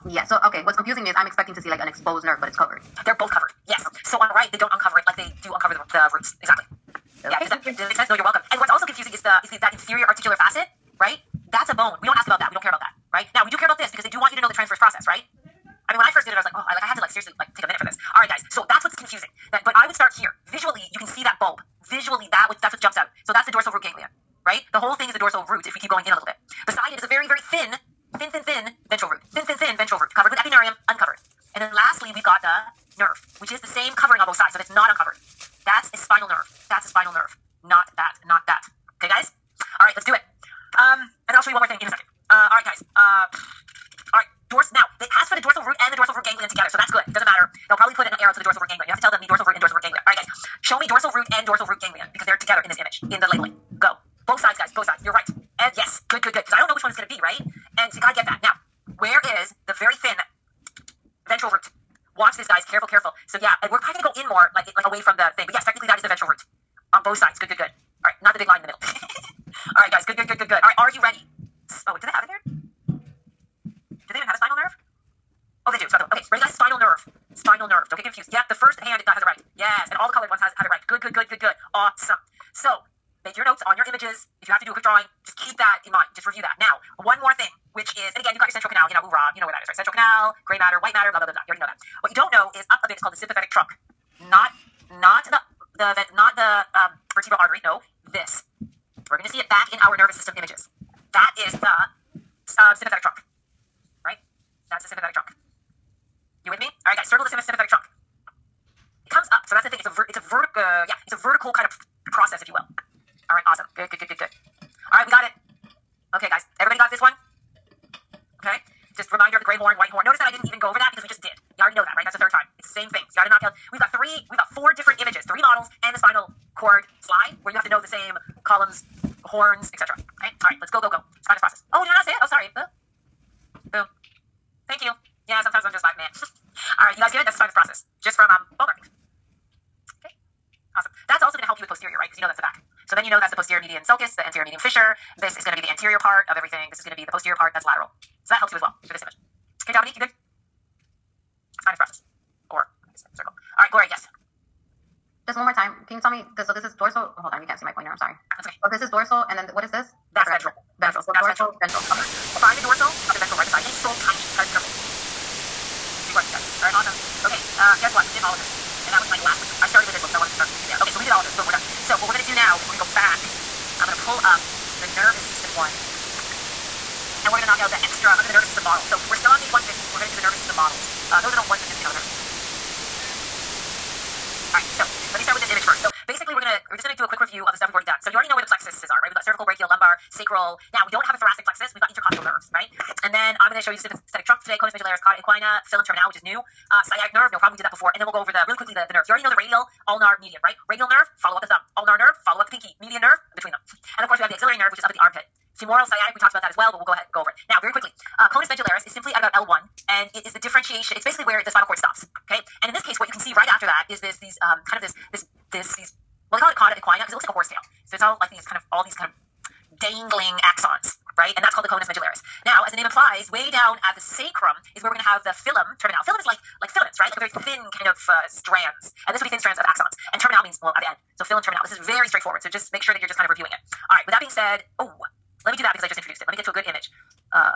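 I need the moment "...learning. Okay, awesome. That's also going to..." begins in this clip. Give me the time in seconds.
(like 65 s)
138 s.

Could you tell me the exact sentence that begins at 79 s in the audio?
Yes, and all the colored ones has have it right.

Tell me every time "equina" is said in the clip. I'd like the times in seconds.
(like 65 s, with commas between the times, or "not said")
195 s, 216 s.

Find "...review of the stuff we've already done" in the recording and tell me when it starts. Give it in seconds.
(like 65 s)
187 s.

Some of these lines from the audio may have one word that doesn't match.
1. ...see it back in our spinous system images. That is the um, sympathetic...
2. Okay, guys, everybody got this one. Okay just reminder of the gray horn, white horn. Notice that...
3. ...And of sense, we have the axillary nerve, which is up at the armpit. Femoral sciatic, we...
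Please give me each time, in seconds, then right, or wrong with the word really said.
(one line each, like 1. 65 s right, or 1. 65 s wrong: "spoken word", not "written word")
1. 99 s wrong: "nervous", not "spinous"
2. 116 s right
3. 203 s wrong: "course", not "sense".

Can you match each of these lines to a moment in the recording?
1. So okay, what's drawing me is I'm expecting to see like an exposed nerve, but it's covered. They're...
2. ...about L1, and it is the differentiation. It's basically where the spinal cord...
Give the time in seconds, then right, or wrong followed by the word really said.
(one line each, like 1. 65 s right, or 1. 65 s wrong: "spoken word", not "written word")
1. 0 s wrong: "confusing", not "drawing"
2. 209 s right.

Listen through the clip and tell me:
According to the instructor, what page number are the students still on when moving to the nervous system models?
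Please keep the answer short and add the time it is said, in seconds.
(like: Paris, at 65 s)
150, at 179 s.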